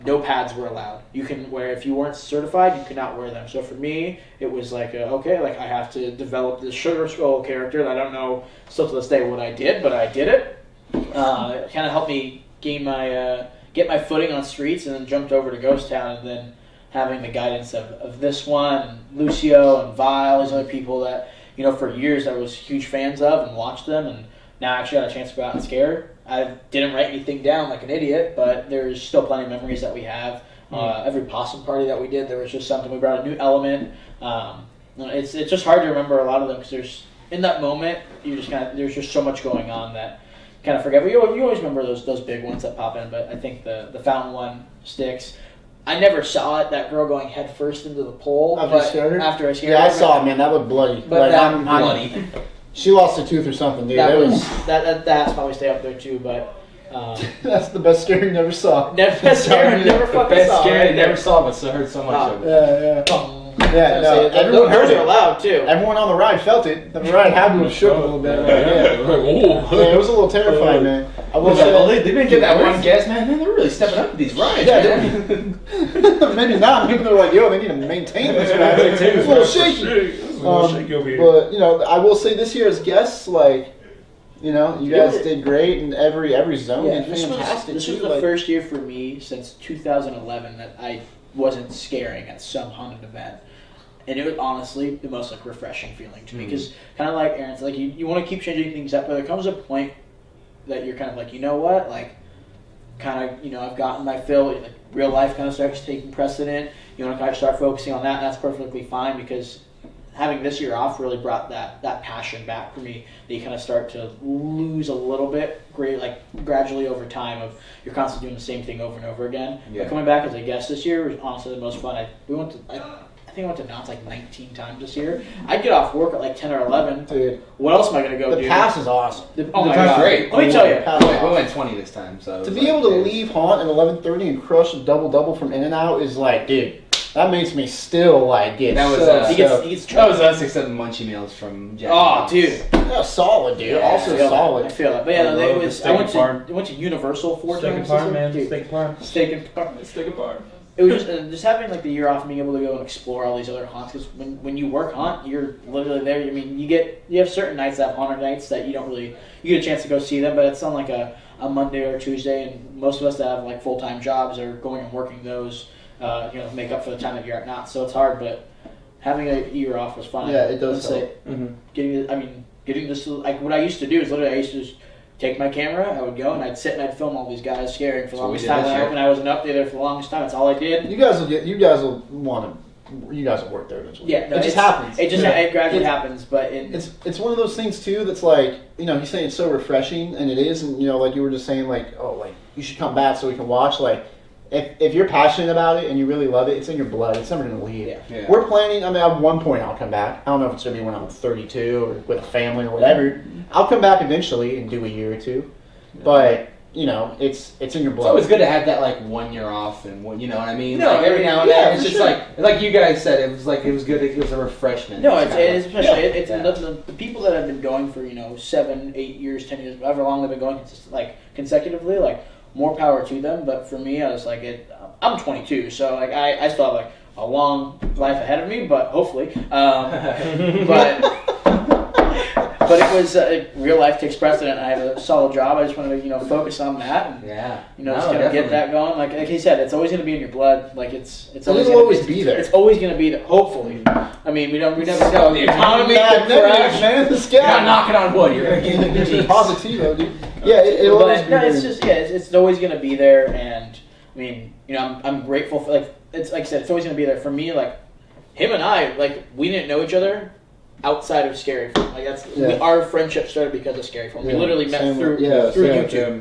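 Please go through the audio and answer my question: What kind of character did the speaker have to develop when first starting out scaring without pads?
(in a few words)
Sugar skull.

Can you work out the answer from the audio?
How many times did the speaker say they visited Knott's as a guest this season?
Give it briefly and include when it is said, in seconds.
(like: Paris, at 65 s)
19, at 124 s.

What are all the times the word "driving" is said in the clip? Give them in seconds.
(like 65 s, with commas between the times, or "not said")
not said.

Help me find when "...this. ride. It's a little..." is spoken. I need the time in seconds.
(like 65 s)
78 s.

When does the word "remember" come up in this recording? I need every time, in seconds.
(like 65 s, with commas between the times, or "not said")
35 s, 41 s.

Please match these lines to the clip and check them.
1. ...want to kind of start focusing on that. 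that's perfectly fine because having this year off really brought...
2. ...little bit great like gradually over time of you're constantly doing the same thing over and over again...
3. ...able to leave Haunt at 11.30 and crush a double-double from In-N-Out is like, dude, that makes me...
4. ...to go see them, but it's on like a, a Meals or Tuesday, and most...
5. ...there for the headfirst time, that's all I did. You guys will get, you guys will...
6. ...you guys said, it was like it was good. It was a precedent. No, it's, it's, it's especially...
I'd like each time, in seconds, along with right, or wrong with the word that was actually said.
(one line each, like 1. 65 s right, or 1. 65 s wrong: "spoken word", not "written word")
1. 107 s right
2. 114 s right
3. 132 s right
4. 159 s wrong: "Monday", not "Meals"
5. 179 s wrong: "longest", not "headfirst"
6. 212 s wrong: "refreshment", not "precedent".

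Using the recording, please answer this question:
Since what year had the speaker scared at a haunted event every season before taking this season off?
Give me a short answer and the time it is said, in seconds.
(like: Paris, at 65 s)
2011, at 89 s.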